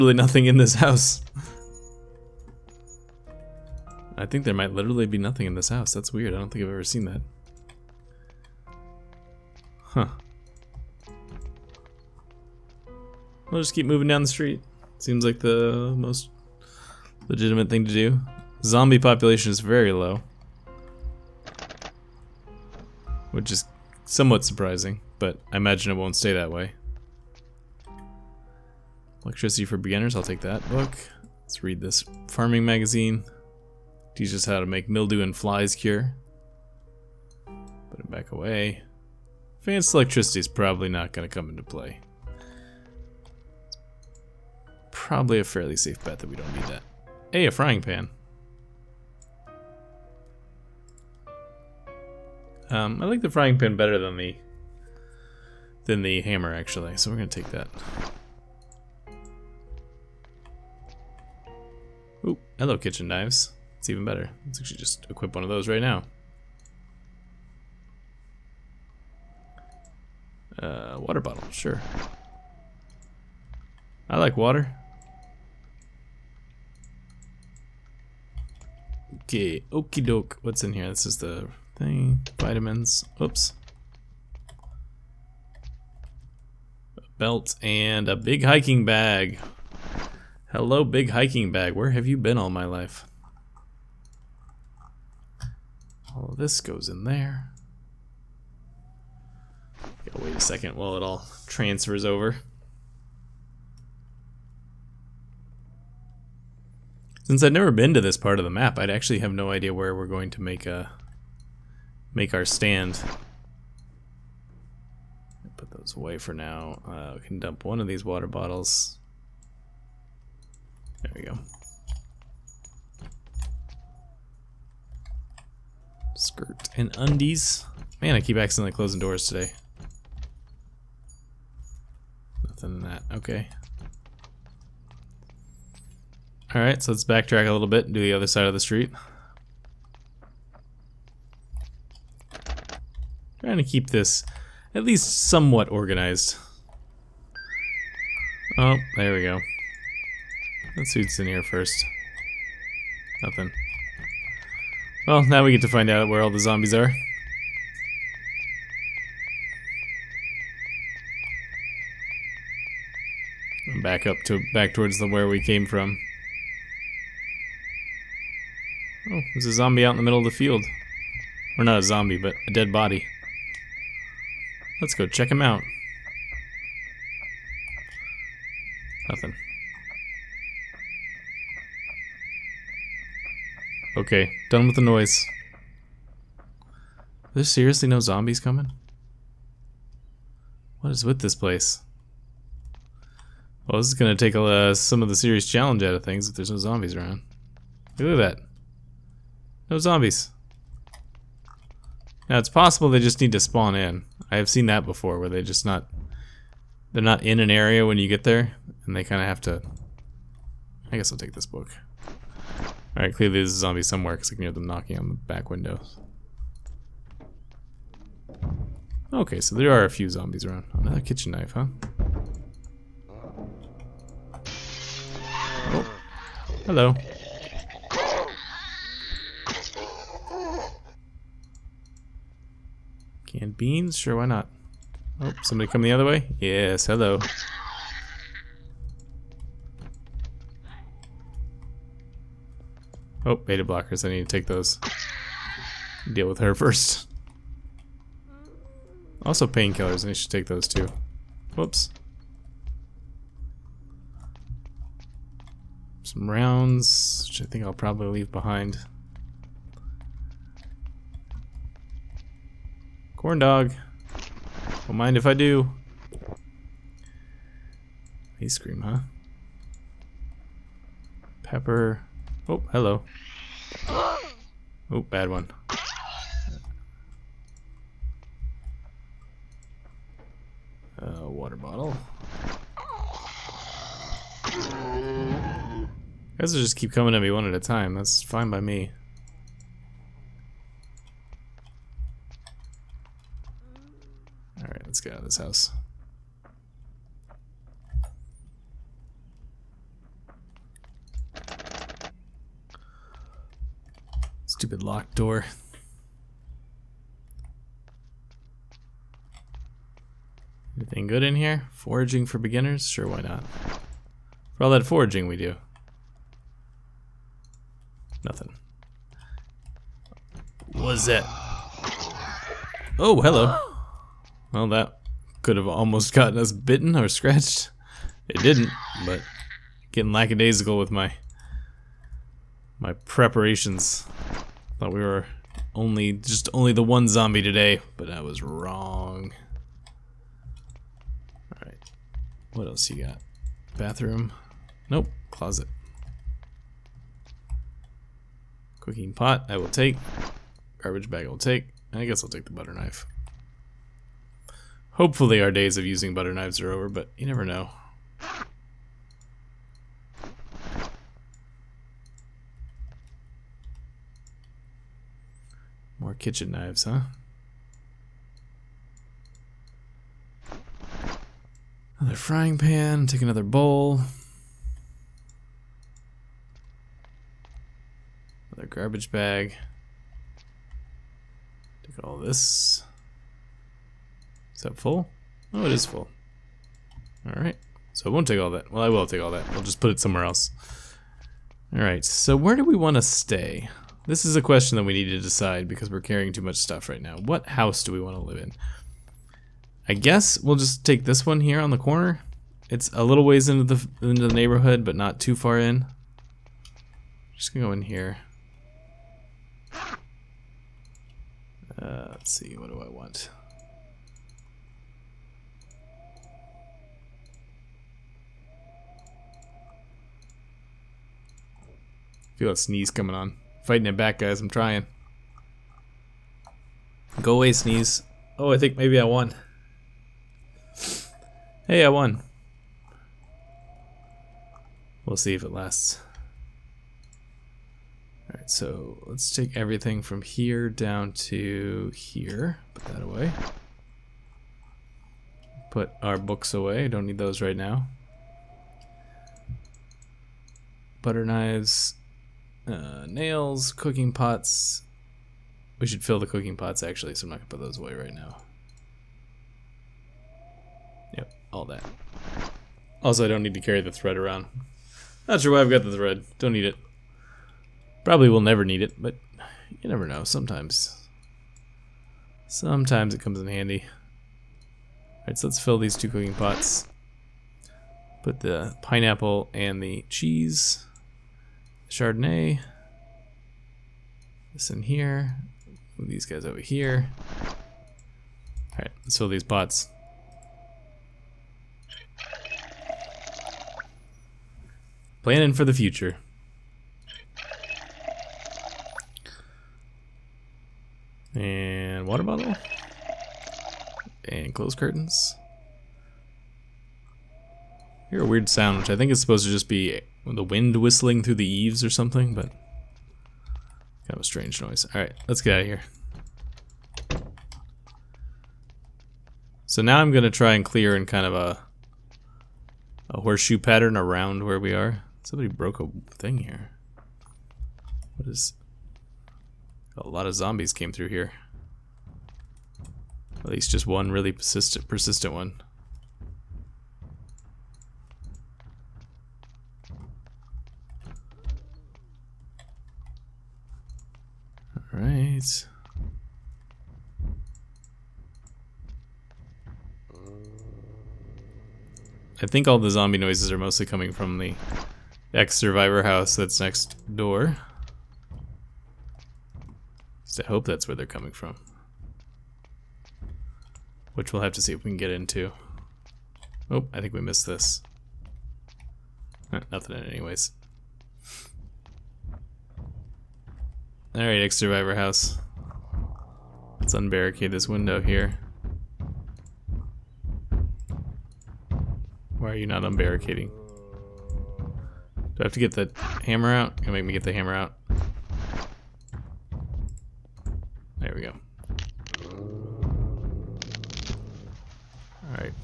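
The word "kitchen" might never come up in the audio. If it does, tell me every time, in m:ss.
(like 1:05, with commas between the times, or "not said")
1:02, 3:41, 6:06.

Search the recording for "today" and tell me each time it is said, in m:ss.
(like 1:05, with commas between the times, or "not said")
2:09, 5:37.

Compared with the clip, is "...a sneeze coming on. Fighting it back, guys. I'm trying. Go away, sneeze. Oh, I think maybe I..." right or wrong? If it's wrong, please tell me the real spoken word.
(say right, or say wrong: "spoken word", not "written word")
right.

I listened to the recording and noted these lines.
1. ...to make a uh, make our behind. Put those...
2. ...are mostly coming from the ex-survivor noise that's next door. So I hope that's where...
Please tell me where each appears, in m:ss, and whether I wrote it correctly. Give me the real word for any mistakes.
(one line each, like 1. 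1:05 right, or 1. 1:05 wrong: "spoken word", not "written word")
1. 1:50 wrong: "stand", not "behind"
2. 9:13 wrong: "house", not "noise".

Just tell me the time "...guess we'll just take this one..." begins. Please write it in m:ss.
6:39.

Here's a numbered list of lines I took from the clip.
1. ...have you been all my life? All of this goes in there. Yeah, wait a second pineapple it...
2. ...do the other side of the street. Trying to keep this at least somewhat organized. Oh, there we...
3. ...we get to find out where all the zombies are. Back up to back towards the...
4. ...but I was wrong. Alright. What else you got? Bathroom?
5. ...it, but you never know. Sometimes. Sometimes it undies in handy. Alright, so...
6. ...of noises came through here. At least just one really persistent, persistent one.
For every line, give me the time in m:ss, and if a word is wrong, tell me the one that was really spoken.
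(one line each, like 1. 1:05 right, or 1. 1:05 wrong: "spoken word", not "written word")
1. 1:31 wrong: "while", not "pineapple"
2. 2:17 right
3. 2:35 right
4. 5:37 right
5. 7:48 wrong: "comes", not "undies"
6. 8:50 wrong: "zombies", not "noises".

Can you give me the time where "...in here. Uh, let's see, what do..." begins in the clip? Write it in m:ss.
6:47.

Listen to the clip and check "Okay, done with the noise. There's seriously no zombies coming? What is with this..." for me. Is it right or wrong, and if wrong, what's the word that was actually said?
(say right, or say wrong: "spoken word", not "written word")
right.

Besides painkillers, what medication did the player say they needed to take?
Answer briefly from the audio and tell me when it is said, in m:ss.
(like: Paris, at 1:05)
beta blockers, at 4:03.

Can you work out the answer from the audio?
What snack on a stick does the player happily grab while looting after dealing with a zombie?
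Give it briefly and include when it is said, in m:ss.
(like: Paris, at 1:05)
corn dog, at 4:23.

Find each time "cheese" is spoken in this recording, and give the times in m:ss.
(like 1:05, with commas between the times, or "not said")
8:00.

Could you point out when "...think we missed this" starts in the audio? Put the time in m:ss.
9:27.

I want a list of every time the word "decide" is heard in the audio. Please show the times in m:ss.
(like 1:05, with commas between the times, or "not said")
6:35.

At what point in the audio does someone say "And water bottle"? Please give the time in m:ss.
8:21.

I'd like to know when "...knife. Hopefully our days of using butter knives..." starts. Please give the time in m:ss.
5:52.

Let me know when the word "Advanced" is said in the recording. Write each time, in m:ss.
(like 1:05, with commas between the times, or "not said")
0:39.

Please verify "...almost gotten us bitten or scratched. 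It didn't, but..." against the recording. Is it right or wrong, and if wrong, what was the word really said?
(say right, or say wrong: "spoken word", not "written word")
right.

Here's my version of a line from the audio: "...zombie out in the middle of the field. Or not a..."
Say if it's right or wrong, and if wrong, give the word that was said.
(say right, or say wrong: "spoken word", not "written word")
right.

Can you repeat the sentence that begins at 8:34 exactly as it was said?
Alright, let's get out of here.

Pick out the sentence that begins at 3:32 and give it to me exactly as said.
Alright, clearly there's a zombie somewhere because I can hear them knocking on the back windows.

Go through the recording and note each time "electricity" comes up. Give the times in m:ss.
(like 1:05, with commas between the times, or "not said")
0:29, 0:39.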